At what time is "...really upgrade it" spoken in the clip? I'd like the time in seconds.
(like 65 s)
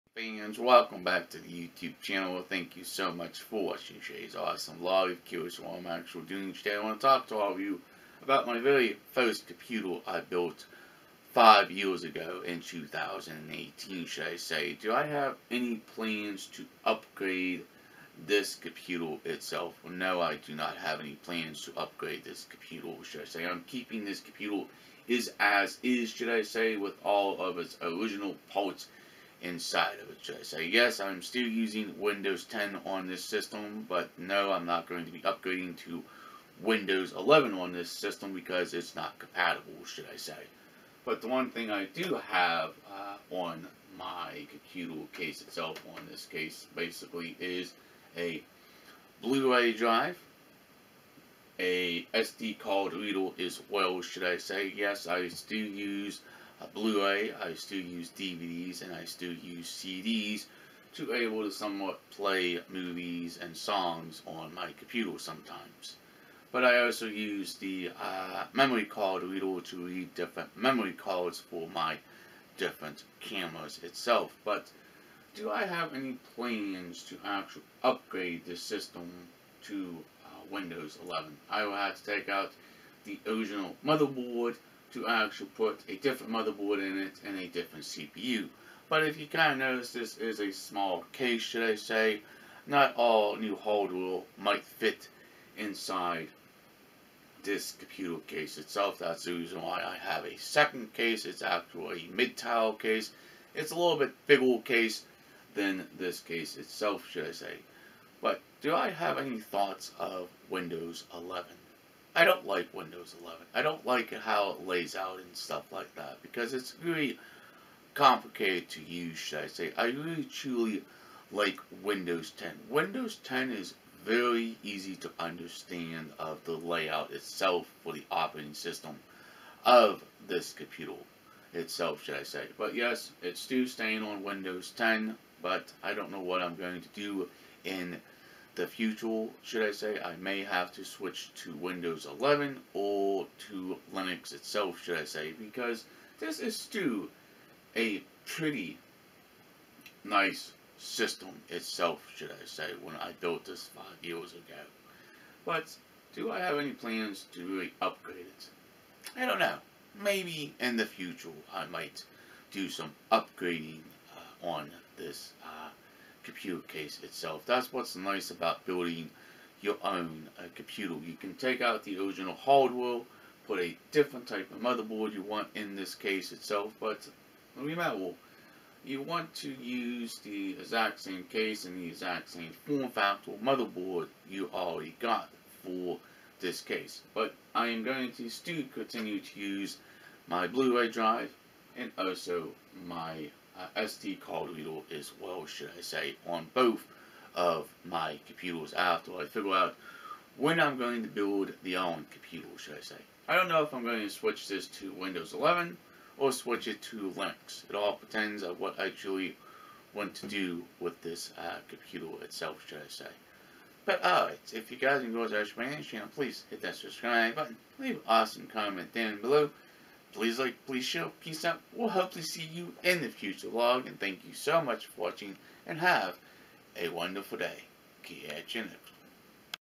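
157 s.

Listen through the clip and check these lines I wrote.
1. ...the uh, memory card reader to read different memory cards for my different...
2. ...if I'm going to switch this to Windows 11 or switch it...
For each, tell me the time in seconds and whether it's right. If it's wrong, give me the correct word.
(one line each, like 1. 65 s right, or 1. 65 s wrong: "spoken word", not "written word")
1. 67 s right
2. 203 s right.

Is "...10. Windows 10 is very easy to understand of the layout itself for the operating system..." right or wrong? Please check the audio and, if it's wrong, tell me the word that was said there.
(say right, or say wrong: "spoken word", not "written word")
right.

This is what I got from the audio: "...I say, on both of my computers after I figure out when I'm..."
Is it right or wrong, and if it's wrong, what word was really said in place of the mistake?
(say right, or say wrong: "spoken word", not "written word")
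right.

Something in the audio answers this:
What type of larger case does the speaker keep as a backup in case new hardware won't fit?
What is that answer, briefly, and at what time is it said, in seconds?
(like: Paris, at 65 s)
Mid-tower case, at 102 s.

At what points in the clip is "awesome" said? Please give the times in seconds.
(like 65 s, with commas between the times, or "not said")
4 s, 218 s.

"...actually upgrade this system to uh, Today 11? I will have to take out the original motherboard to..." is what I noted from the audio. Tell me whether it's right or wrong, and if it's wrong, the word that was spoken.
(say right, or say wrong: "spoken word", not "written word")
wrong: "Windows", not "Today".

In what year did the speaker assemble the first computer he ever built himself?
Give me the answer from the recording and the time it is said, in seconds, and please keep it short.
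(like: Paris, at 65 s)
2018, at 12 s.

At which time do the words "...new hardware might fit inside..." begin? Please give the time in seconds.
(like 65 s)
93 s.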